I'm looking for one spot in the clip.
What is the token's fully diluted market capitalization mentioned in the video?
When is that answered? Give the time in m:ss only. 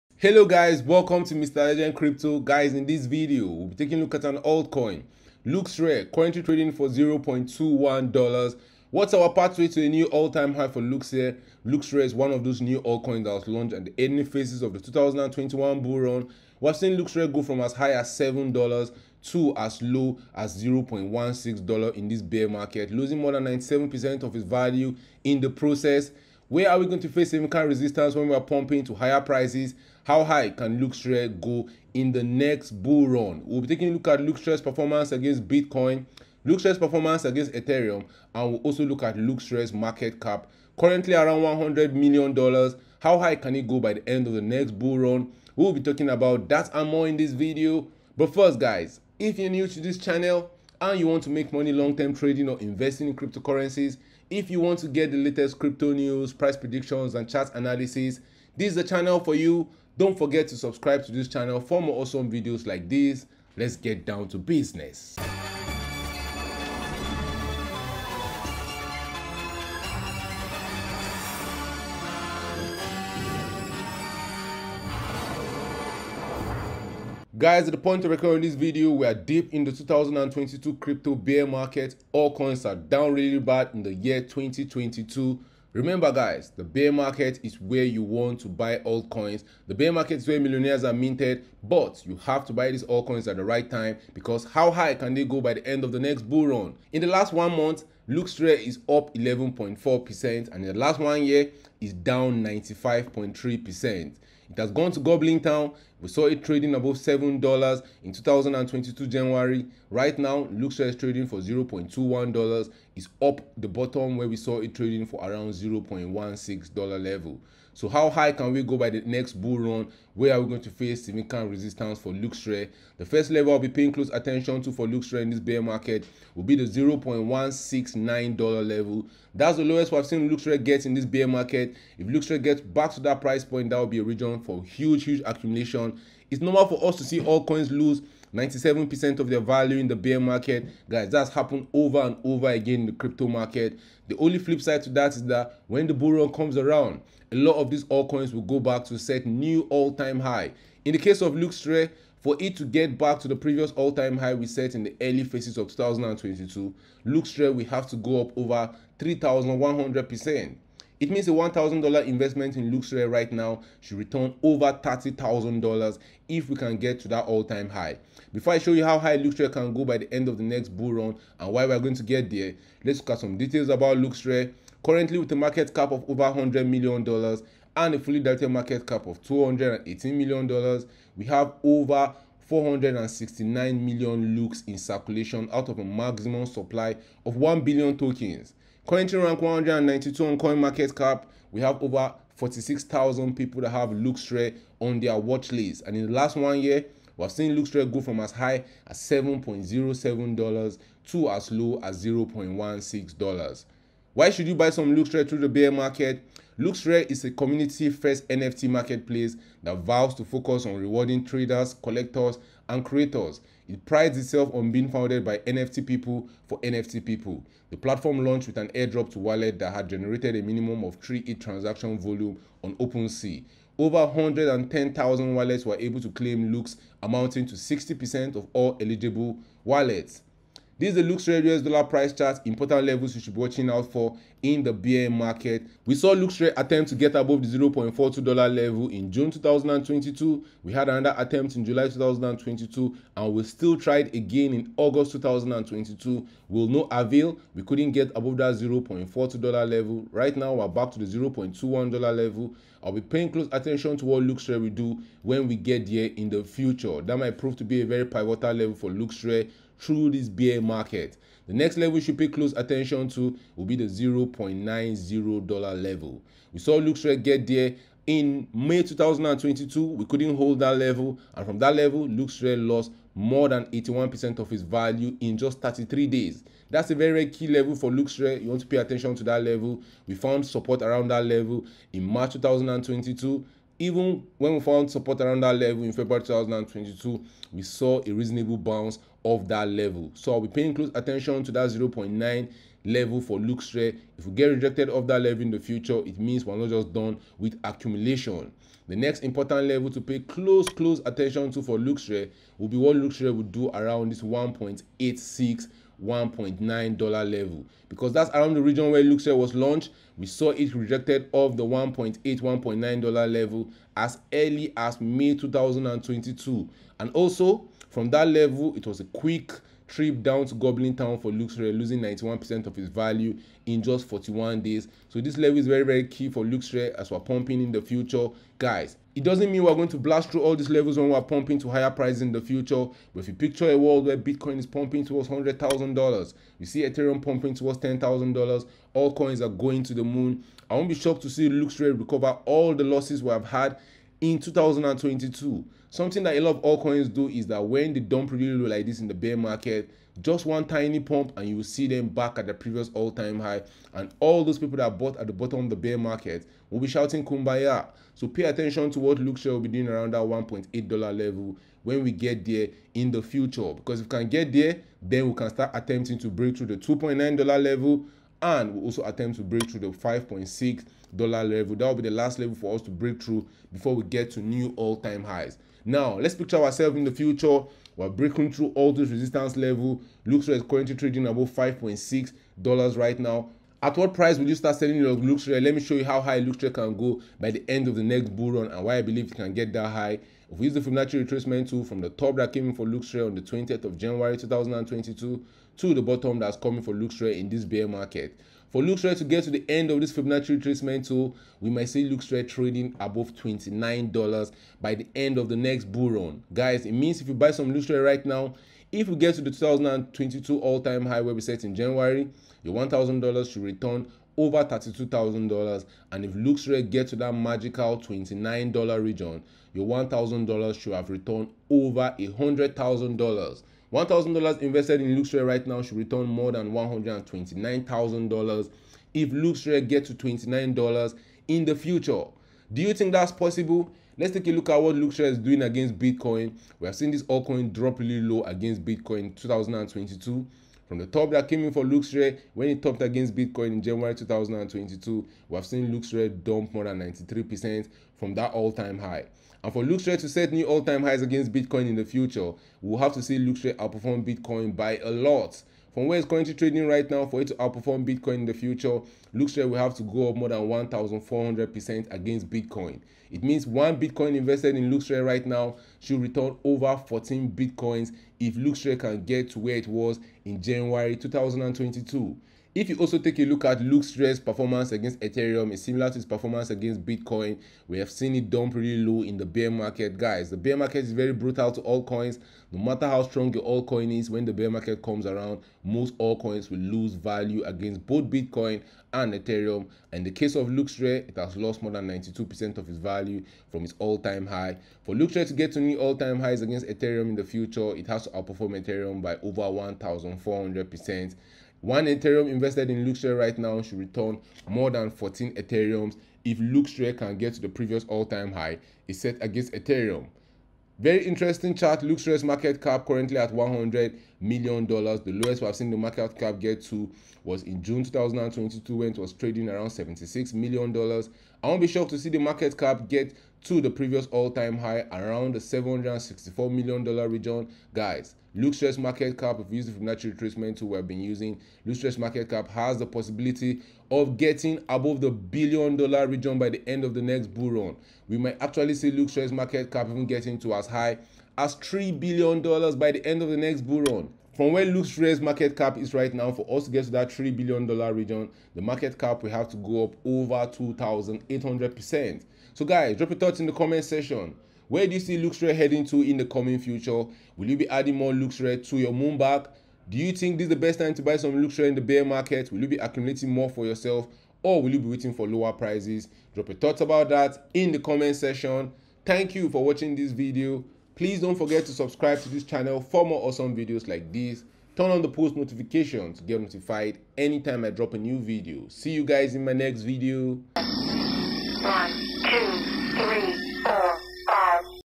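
2:59.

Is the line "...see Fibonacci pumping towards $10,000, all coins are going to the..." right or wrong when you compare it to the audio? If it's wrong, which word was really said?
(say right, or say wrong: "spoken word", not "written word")
wrong: "Ethereum", not "Fibonacci".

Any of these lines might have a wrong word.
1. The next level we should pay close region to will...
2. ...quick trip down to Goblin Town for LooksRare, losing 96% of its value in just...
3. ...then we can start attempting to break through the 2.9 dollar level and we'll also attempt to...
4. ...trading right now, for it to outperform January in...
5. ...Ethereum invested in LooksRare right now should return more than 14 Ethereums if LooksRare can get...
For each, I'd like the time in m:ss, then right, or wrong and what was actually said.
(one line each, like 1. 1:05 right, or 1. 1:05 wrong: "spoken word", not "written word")
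1. 4:21 wrong: "attention", not "region"
2. 5:19 wrong: "91", not "96"
3. 6:05 right
4. 7:36 wrong: "Bitcoin", not "January"
5. 8:22 right.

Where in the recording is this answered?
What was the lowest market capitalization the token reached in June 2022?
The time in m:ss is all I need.
8:39.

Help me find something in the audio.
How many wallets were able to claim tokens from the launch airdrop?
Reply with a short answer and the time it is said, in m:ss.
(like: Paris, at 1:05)
Over 110,000, at 3:44.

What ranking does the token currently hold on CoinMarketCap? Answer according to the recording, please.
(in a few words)
192.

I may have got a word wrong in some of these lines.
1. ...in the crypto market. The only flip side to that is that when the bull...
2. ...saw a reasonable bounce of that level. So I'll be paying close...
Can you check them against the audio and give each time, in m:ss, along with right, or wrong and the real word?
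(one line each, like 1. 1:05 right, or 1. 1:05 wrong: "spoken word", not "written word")
1. 2:22 right
2. 4:47 right.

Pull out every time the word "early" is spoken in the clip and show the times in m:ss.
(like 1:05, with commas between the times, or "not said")
0:14, 2:35, 5:14.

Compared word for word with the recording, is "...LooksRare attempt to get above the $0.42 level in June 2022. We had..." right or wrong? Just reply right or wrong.
right.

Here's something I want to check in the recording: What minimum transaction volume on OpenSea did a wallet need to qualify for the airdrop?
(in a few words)
3 ETH.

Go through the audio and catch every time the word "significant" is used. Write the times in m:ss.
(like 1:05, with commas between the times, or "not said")
0:27, 2:01.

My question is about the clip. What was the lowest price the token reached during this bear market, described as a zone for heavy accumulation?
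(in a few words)
$0.169.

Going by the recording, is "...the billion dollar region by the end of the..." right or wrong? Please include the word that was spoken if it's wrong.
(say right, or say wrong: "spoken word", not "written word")
right.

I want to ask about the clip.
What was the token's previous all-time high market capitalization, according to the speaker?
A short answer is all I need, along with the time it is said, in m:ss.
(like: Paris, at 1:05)
$764 million, at 8:45.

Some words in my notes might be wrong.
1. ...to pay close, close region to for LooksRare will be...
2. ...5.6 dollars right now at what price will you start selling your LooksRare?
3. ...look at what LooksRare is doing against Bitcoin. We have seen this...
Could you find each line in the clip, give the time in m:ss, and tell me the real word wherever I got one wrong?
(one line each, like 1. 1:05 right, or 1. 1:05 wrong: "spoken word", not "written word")
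1. 4:59 wrong: "attention", not "region"
2. 6:21 right
3. 7:14 right.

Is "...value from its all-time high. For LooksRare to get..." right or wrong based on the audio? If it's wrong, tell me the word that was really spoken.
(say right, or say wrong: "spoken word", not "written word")
right.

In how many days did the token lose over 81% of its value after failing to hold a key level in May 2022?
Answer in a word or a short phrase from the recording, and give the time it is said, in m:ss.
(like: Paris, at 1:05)
33 days, at 4:35.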